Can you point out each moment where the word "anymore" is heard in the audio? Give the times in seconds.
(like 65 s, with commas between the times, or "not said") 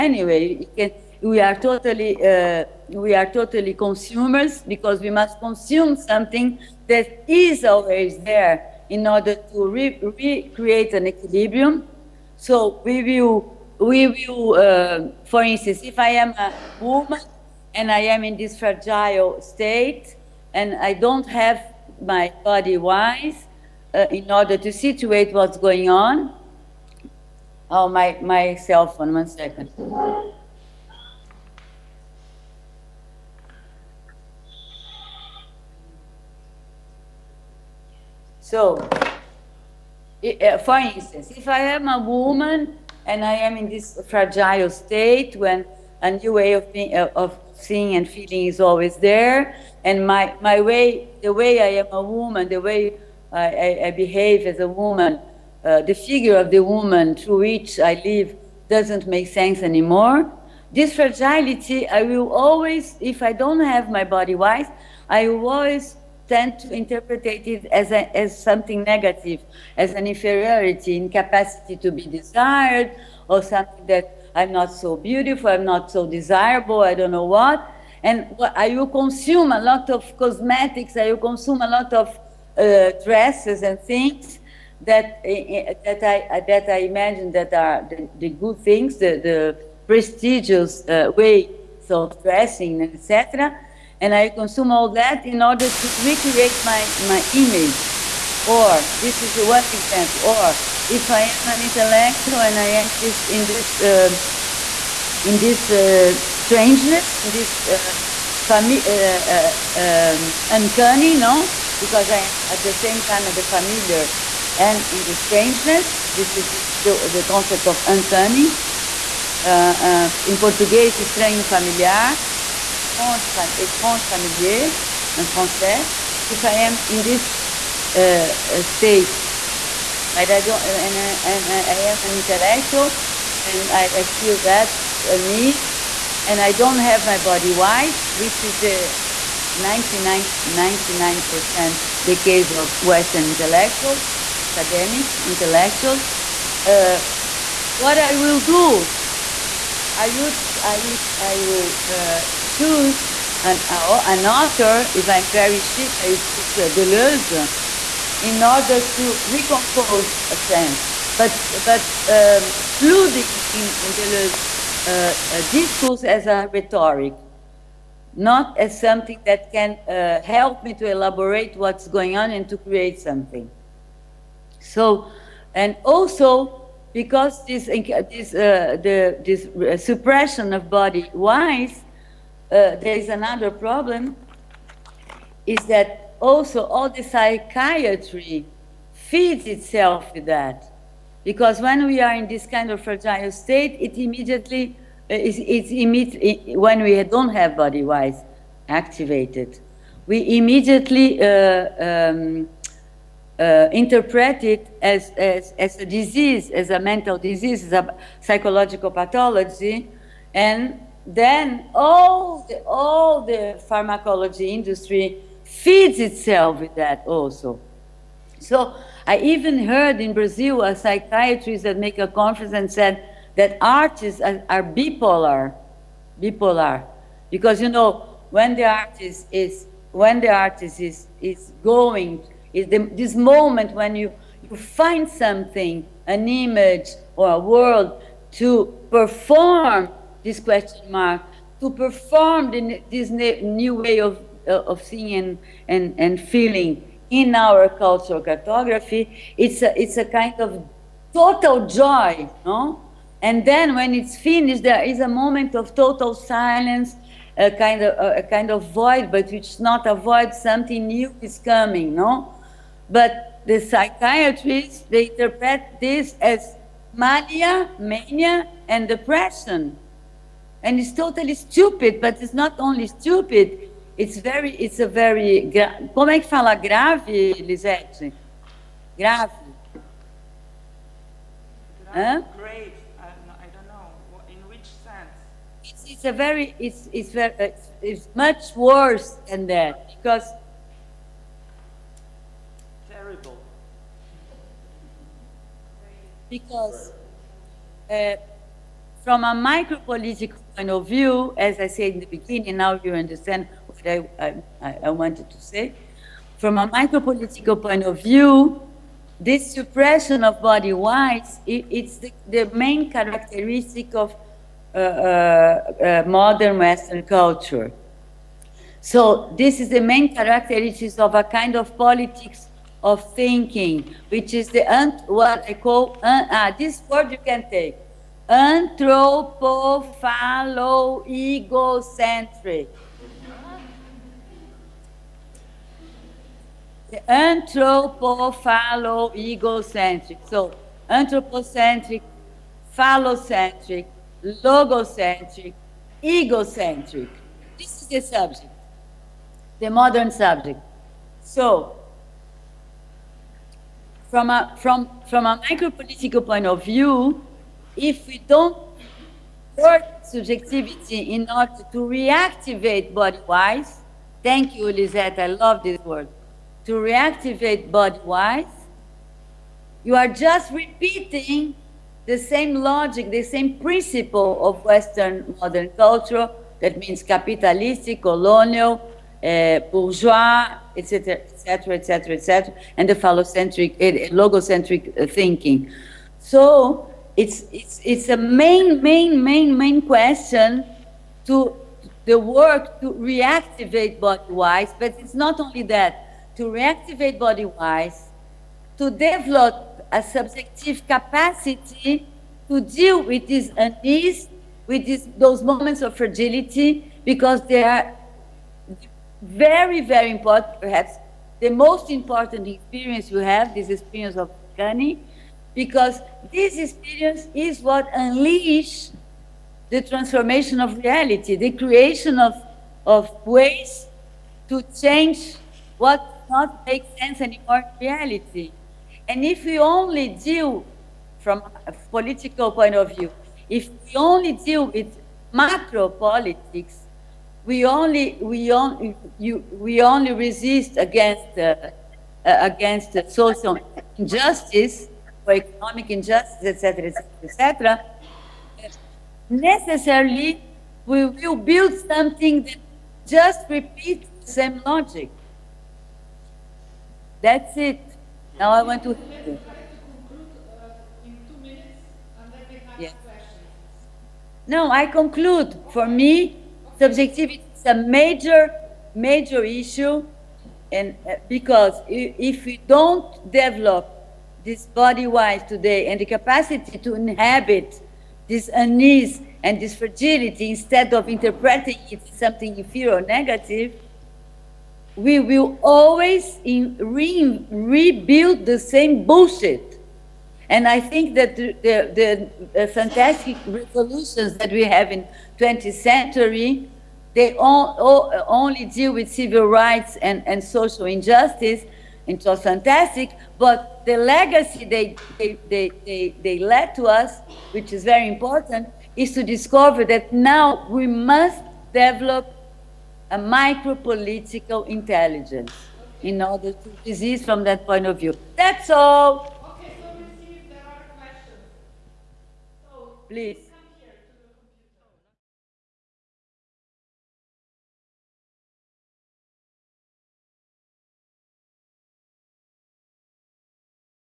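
59 s, 427 s.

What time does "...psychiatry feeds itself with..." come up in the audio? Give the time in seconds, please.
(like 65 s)
187 s.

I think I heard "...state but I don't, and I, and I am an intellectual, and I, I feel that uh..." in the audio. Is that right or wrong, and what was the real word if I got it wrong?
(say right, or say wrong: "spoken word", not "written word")
right.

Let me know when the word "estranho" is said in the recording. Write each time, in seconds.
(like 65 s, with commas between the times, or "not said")
120 s.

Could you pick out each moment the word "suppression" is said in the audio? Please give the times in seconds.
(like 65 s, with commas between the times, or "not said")
179 s, 309 s.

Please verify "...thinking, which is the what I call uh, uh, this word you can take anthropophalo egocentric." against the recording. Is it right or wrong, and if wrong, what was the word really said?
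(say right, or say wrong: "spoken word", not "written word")
right.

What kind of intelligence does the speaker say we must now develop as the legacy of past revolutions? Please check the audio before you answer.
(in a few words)
micro-political intelligence.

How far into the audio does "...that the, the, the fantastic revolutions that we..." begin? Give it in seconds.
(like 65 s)
491 s.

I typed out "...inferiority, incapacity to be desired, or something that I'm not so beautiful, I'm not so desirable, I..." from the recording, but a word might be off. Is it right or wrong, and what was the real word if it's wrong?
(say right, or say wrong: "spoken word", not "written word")
right.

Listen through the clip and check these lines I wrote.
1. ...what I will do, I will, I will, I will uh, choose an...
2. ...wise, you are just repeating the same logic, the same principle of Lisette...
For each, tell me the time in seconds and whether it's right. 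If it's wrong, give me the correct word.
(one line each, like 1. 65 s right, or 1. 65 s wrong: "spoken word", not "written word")
1. 147 s right
2. 368 s wrong: "Western", not "Lisette".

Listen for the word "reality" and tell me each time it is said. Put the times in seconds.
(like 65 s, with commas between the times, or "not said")
420 s, 427 s.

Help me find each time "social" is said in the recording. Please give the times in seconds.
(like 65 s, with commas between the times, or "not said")
443 s, 500 s.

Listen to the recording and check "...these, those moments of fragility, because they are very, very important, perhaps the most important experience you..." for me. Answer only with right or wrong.
right.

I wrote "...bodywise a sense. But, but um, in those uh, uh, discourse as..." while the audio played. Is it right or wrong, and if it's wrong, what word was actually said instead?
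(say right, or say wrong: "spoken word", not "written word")
wrong: "recompose", not "bodywise".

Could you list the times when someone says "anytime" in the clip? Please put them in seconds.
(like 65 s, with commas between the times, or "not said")
not said.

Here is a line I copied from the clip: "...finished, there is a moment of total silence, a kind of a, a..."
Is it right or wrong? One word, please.
right.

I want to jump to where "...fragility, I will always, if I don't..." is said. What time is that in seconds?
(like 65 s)
60 s.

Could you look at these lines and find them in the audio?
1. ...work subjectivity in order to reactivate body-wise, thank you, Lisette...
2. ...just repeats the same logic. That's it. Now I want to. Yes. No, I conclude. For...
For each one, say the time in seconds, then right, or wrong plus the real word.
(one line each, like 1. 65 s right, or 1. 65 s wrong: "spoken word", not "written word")
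1. 359 s right
2. 453 s right.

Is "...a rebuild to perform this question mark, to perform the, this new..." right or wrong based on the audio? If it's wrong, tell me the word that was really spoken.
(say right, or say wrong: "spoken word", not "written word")
wrong: "world", not "rebuild".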